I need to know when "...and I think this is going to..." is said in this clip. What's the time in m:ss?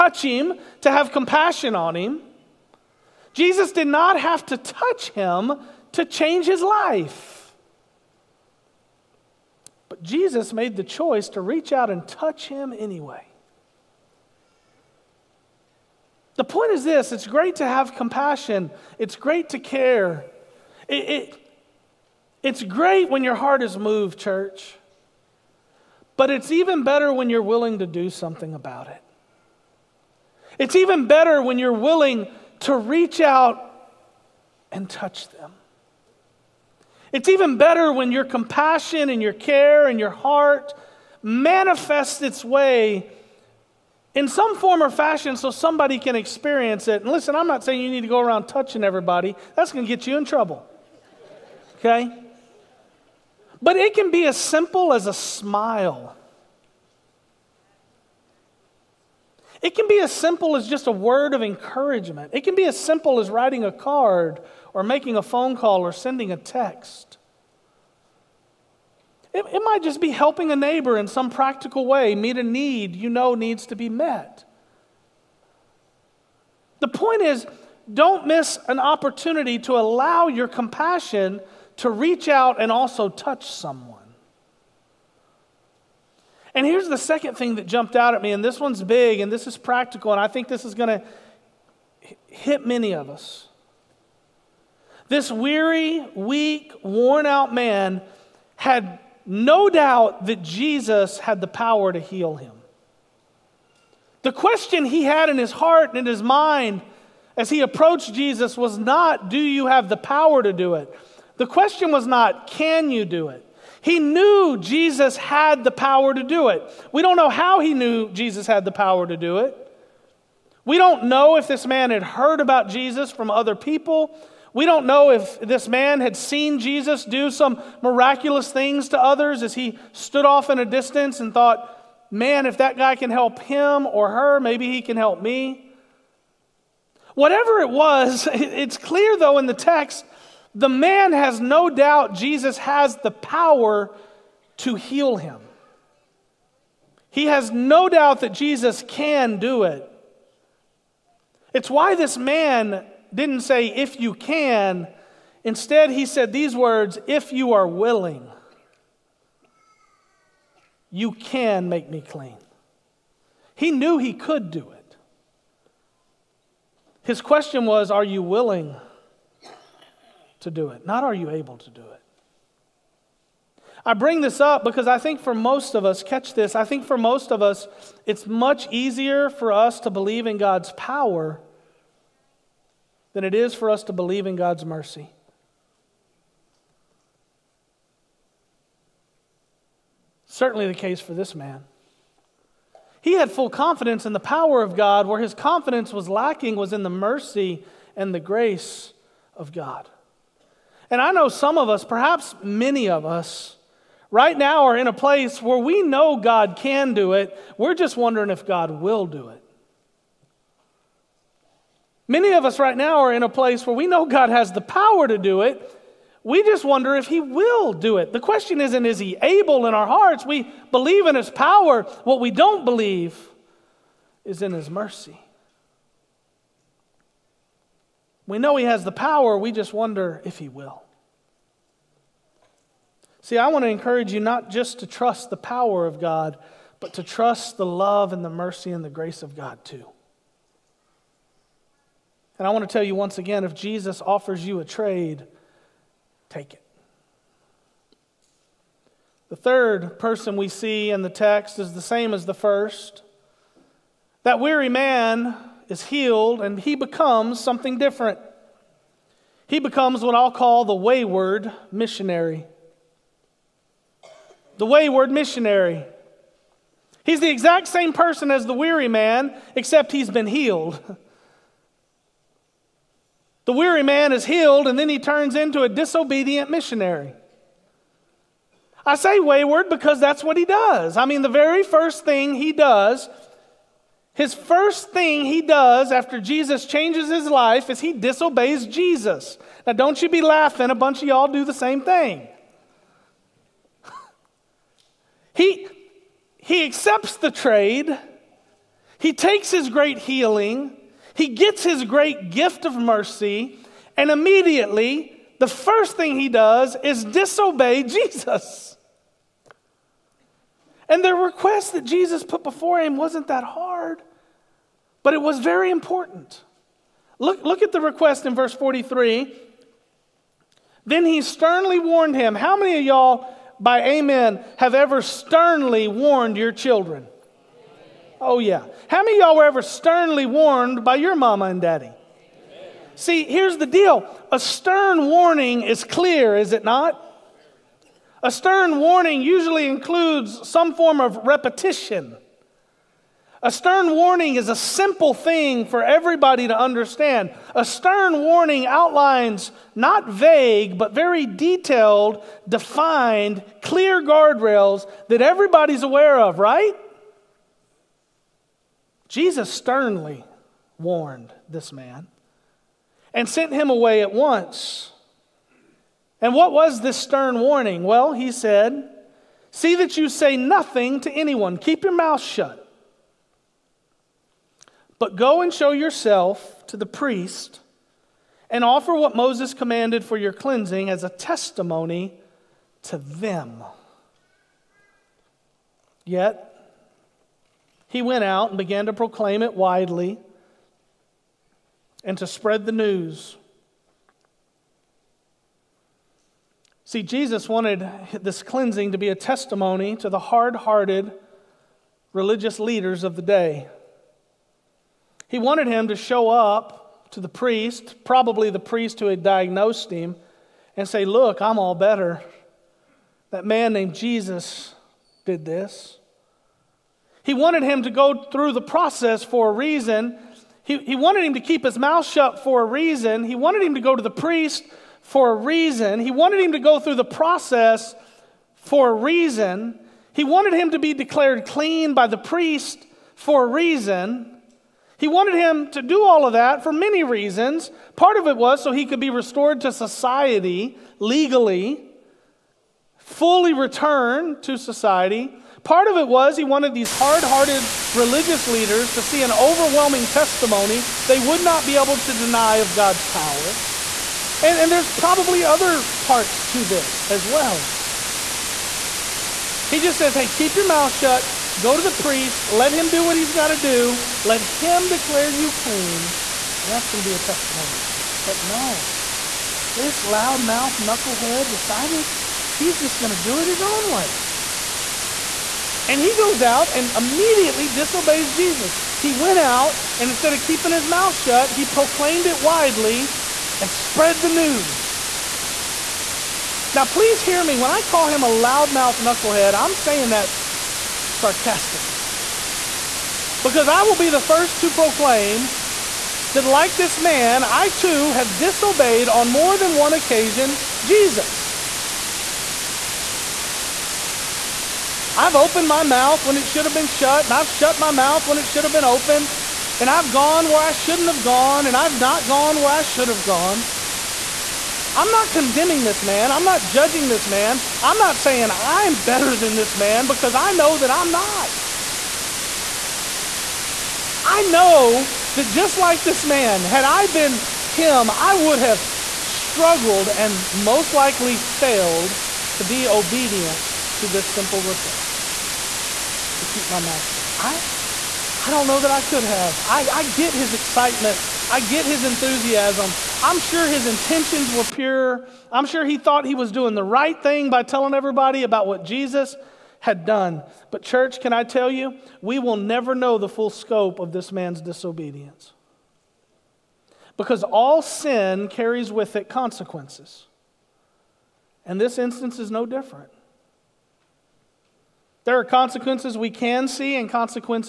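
1:30.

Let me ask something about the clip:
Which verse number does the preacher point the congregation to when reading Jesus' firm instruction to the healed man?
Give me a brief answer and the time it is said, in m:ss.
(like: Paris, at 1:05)
43, at 5:18.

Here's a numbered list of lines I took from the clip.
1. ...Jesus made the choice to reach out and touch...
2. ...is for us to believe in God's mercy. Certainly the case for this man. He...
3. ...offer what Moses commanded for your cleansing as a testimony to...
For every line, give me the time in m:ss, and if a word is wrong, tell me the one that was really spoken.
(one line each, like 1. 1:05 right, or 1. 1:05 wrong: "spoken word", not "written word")
1. 0:10 right
2. 3:03 right
3. 6:18 right.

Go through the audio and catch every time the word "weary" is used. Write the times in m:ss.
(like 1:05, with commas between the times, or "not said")
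1:35, 4:14, 4:28, 4:33.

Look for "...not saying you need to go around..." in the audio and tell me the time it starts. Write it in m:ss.
0:47.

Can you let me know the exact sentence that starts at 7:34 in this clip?
And, and there's probably other parts to this as well.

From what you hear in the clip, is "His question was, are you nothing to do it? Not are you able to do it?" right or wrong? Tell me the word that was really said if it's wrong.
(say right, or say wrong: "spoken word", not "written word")
wrong: "willing", not "nothing".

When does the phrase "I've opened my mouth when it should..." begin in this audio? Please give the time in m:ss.
8:25.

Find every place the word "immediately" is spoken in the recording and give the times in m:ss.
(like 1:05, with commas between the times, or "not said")
5:04, 7:56.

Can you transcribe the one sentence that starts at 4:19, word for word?
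He becomes what I'll call the wayward missionary.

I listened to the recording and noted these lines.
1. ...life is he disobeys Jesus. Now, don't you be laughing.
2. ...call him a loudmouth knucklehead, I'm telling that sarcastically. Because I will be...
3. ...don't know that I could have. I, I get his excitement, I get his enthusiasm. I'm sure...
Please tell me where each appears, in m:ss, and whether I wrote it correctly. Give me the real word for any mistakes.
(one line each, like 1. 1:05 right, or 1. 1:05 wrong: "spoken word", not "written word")
1. 4:47 right
2. 8:07 wrong: "saying", not "telling"
3. 8:58 right.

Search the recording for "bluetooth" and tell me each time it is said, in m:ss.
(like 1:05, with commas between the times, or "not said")
not said.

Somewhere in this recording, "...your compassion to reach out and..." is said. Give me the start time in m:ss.
1:20.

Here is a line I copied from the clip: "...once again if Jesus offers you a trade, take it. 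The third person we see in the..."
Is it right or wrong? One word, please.
right.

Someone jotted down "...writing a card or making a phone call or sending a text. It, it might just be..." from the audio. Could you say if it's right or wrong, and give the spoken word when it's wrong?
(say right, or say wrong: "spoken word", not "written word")
right.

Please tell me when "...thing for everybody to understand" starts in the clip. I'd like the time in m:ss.
5:45.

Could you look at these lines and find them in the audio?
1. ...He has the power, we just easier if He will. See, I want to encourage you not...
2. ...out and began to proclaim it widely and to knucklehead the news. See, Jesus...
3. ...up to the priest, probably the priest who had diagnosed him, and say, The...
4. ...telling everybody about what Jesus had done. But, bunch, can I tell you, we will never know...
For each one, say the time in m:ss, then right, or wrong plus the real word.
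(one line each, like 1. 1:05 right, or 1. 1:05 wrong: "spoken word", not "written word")
1. 3:48 wrong: "wonder", not "easier"
2. 6:28 wrong: "spread", not "knucklehead"
3. 6:46 wrong: "Look", not "The"
4. 9:07 wrong: "church", not "bunch".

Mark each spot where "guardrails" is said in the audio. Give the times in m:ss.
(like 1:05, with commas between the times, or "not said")
5:54.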